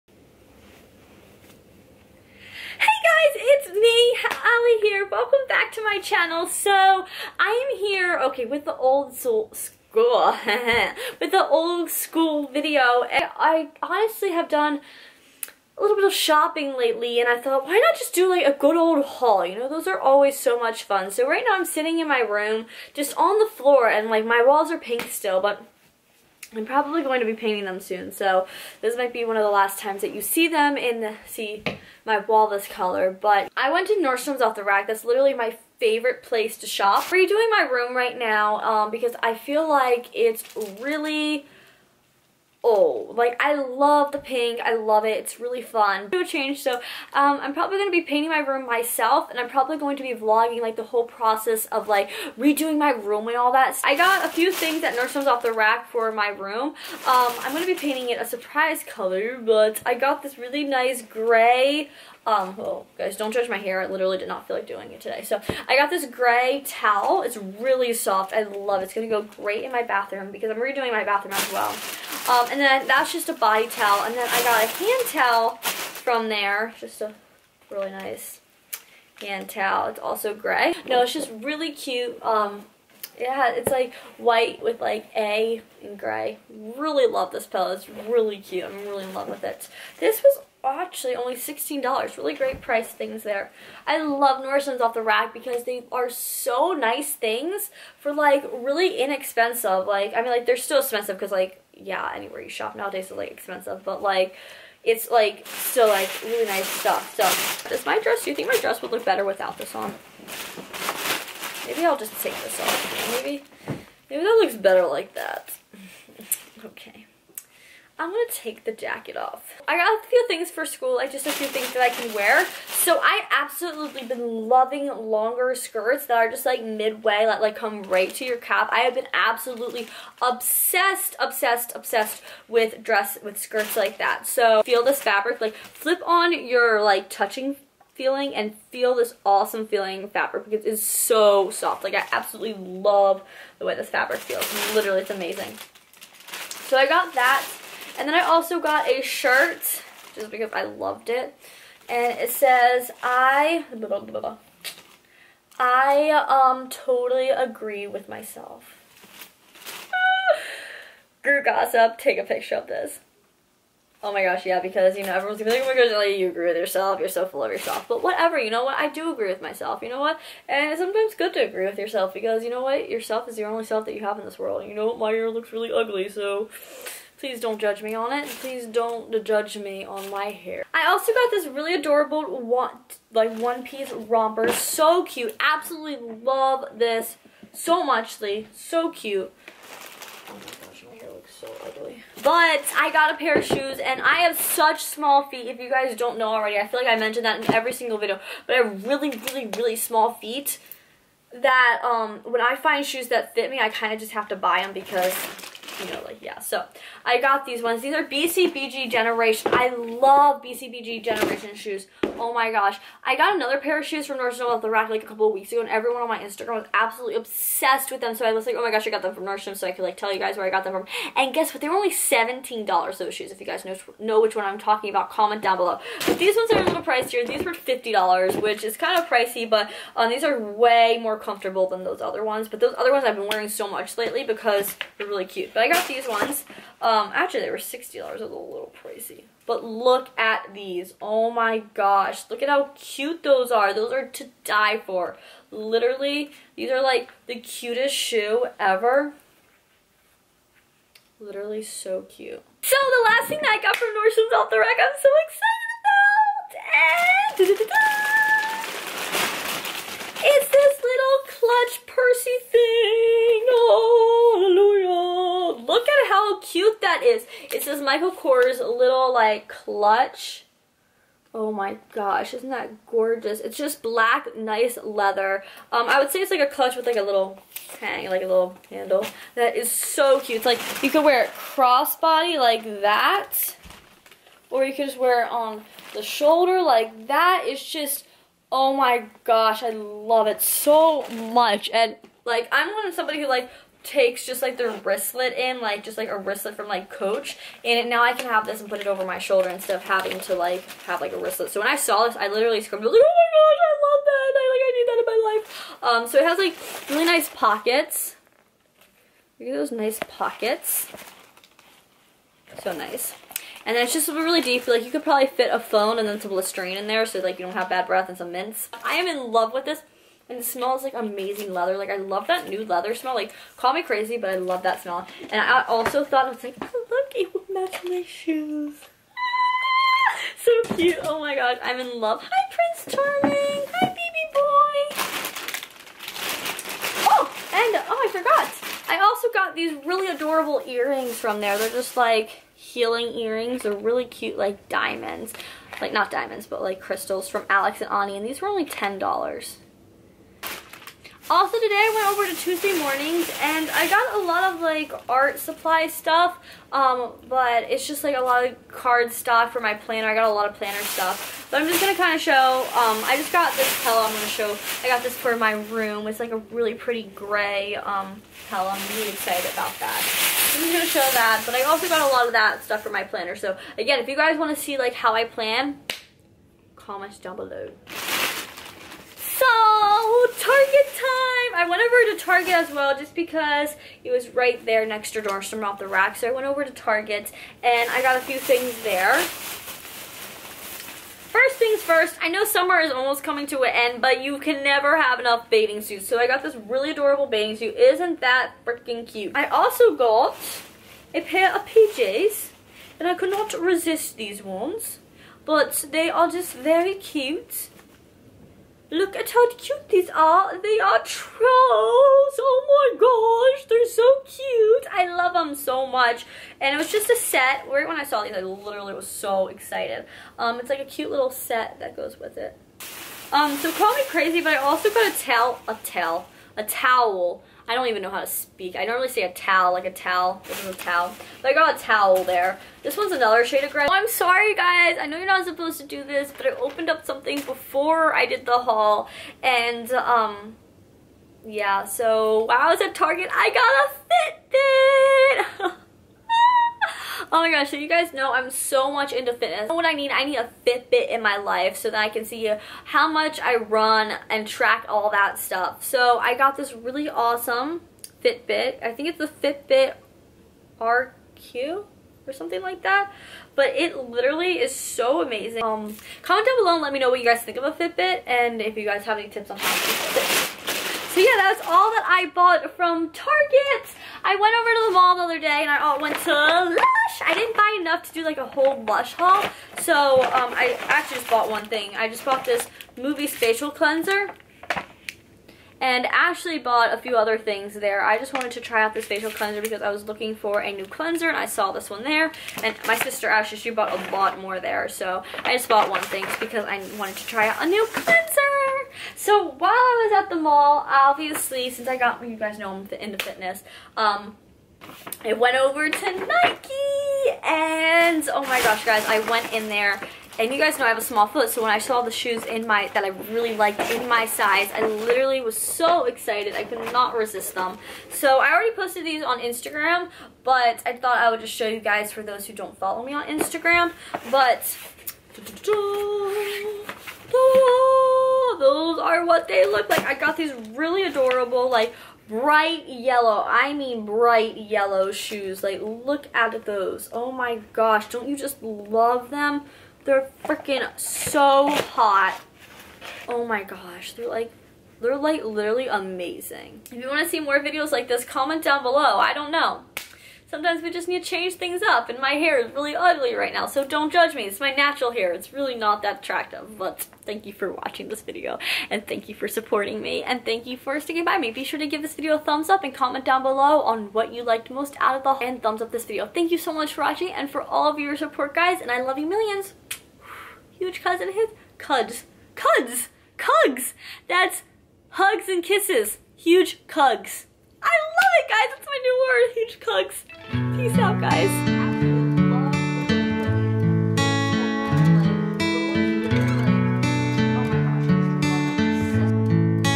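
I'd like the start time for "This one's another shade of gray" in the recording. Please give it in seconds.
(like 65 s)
432 s.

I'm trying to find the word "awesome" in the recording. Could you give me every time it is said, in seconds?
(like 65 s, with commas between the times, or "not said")
139 s, 457 s.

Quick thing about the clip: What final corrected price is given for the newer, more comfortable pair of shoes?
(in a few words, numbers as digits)
$60.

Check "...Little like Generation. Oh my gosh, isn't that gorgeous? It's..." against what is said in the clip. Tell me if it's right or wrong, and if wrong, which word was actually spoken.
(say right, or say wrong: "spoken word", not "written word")
wrong: "Clutch", not "Generation".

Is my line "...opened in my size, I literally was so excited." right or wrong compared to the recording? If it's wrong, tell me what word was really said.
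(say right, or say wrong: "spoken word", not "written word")
wrong: "liked", not "opened".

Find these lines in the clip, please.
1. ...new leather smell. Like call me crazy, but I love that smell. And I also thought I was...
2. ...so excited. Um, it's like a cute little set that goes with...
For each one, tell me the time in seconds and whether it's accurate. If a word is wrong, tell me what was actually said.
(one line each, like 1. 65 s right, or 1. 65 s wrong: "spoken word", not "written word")
1. 322 s right
2. 419 s right.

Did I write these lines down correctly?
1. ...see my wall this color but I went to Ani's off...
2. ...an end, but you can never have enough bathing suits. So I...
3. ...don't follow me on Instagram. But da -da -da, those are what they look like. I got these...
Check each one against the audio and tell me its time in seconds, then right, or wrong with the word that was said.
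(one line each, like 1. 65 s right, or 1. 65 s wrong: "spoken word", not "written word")
1. 31 s wrong: "Nordstrom", not "Ani"
2. 393 s right
3. 522 s right.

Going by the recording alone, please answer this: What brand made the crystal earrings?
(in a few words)
Alex and Ani.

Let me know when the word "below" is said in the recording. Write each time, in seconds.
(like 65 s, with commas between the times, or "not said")
225 s, 377 s, 466 s, 548 s, 563 s.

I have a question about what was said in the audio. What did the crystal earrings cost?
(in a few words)
$10.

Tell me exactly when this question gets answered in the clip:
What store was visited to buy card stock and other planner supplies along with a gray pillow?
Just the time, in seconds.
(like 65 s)
352 s.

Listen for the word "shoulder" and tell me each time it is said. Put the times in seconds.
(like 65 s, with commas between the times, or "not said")
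286 s, 299 s.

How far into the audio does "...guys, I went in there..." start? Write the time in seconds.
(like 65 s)
508 s.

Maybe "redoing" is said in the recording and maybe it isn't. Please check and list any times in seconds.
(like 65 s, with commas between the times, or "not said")
37 s, 52 s, 70 s.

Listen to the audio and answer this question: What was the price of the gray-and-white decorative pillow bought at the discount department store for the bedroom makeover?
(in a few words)
$16.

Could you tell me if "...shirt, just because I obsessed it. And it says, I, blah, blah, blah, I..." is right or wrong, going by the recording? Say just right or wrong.
wrong.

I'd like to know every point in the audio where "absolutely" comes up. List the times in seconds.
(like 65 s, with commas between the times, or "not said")
123 s, 129 s, 142 s, 185 s, 216 s.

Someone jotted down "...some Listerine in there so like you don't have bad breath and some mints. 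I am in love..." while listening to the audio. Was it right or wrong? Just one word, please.
right.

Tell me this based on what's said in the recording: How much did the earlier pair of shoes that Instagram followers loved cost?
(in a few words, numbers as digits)
$17.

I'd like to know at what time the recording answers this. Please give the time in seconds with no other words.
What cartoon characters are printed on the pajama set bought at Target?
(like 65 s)
410 s.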